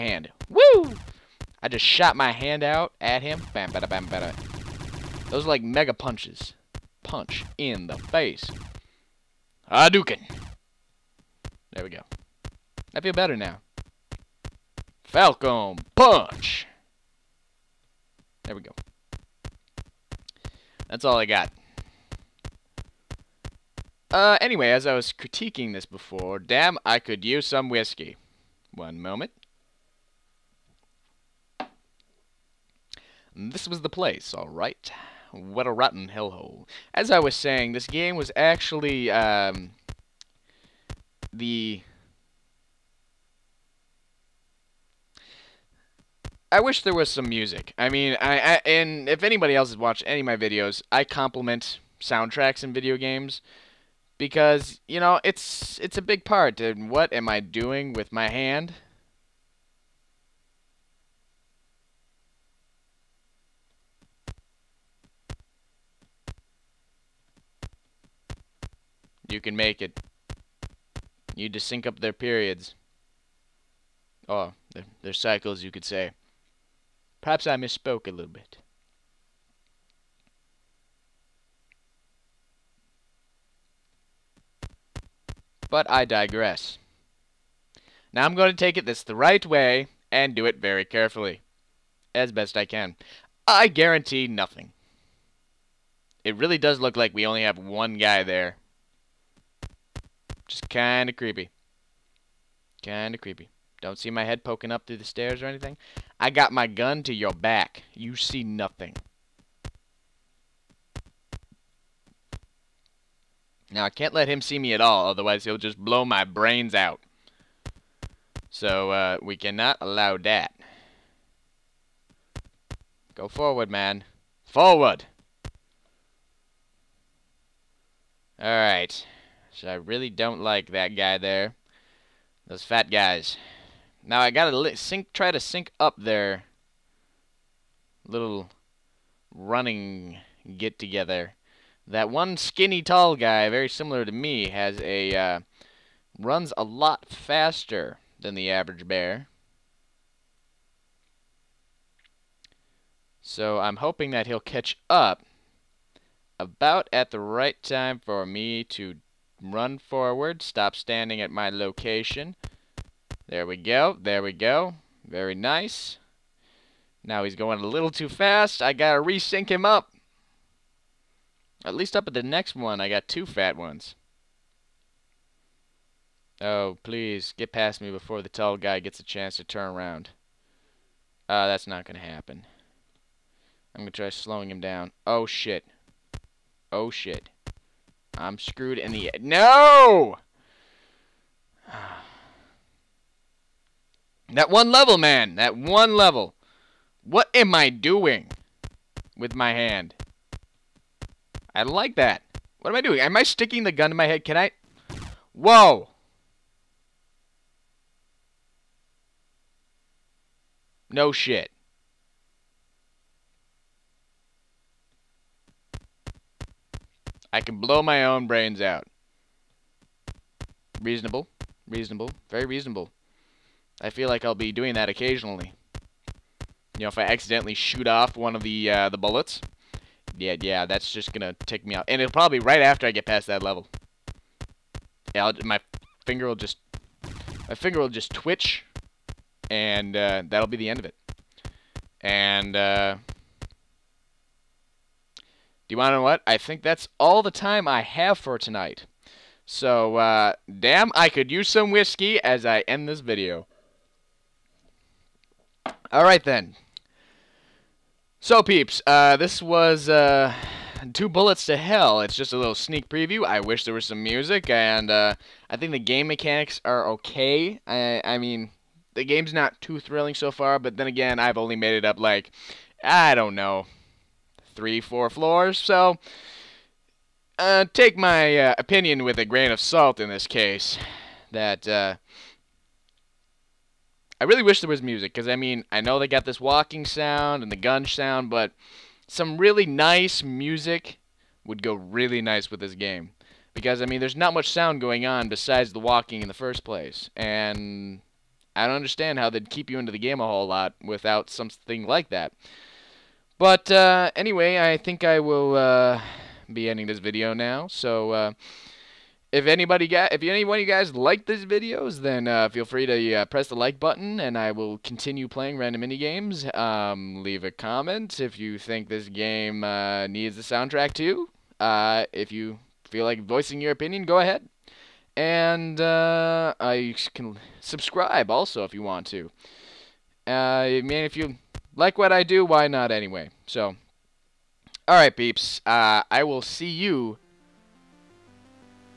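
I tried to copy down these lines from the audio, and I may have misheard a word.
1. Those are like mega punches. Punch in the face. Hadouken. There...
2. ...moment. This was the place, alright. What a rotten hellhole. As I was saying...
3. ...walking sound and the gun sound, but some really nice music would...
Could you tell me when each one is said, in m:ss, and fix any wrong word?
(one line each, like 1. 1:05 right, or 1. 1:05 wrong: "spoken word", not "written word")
1. 0:05 right
2. 0:29 right
3. 4:46 right.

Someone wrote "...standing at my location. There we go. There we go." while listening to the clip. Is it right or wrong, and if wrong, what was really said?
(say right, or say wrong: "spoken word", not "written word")
right.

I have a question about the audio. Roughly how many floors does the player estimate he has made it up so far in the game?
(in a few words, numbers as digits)
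3 or 4.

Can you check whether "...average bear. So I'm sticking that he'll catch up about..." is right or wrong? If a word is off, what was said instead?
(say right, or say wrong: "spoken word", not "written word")
wrong: "hoping", not "sticking".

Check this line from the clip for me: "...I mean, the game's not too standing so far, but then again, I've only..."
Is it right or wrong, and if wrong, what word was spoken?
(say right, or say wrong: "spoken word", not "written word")
wrong: "thrilling", not "standing".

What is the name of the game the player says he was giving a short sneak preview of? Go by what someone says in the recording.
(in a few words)
Two Bullets to Hell.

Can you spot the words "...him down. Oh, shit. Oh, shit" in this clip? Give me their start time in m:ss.
3:04.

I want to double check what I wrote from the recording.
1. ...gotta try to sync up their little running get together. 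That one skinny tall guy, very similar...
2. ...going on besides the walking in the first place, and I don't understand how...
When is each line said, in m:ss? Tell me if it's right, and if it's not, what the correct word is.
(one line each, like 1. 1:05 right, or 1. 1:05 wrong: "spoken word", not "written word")
1. 2:14 right
2. 4:54 right.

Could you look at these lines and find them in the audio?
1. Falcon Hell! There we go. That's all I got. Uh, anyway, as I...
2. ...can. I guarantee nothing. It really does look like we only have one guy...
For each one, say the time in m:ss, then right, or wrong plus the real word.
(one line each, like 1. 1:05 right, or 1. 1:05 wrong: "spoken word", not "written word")
1. 0:15 wrong: "Punch", not "Hell"
2. 1:32 right.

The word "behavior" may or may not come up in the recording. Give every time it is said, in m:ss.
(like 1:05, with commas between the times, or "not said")
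not said.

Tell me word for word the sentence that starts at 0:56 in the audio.
And what am I doing with my hand?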